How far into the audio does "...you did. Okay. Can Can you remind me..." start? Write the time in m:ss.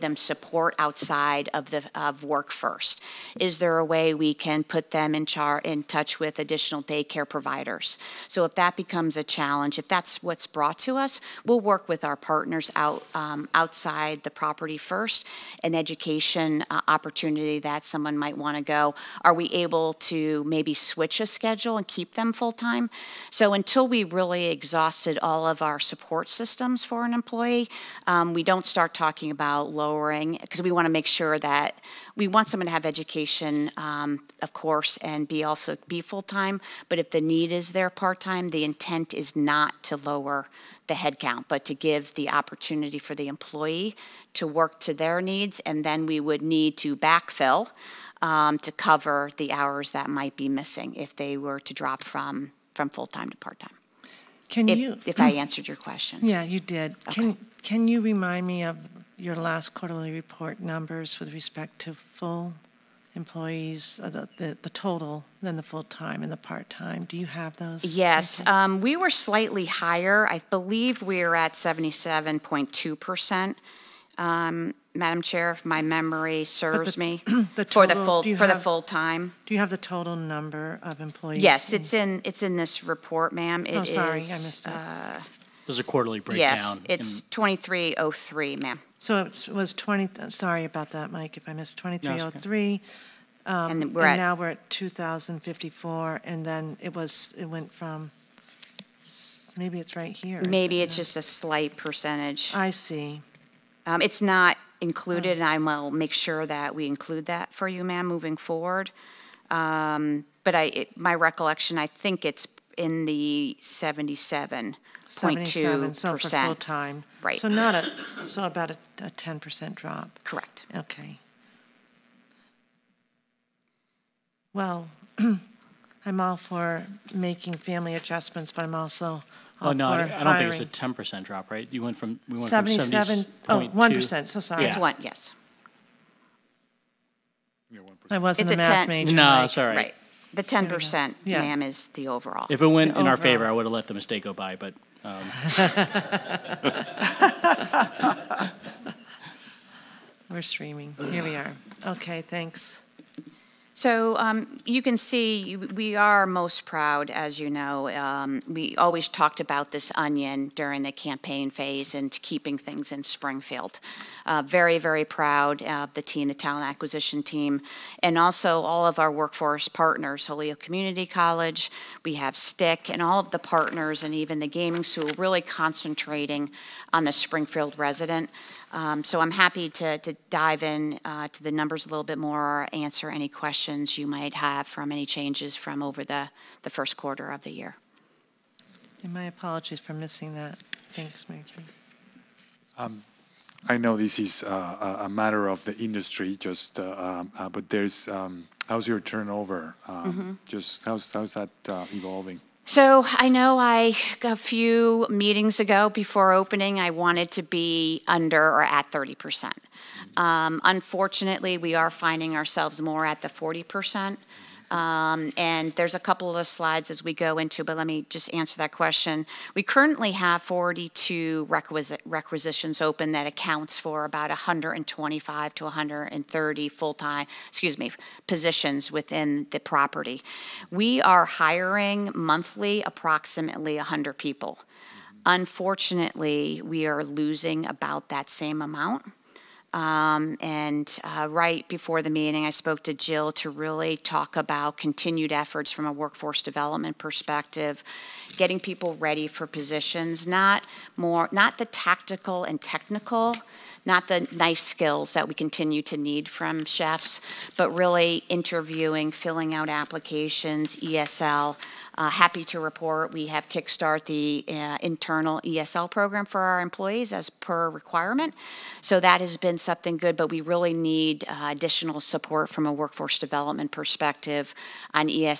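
0:56.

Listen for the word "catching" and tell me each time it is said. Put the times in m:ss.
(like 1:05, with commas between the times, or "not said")
not said.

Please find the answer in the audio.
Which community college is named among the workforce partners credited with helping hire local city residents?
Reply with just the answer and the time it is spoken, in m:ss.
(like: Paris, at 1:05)
Holyoke Community College, at 2:50.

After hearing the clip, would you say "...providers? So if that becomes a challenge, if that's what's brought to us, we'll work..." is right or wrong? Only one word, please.
right.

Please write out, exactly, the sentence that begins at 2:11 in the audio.
You went from, we went from 77, Oh, one percent.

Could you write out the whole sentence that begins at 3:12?
Um, I know this is uh, a matter of the industry, just uh, um, uh, but there's um, how's your turnover?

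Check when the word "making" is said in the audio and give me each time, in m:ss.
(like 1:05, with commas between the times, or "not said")
2:07.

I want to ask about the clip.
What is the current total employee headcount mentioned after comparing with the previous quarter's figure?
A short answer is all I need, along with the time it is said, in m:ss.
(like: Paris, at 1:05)
2,054, at 1:34.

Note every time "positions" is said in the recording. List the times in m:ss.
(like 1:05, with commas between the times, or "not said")
3:48, 4:09.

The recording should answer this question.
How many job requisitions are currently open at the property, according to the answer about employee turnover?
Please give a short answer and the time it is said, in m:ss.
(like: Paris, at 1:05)
42, at 3:40.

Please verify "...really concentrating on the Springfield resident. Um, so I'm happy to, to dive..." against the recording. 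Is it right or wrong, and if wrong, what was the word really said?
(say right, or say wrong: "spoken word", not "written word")
right.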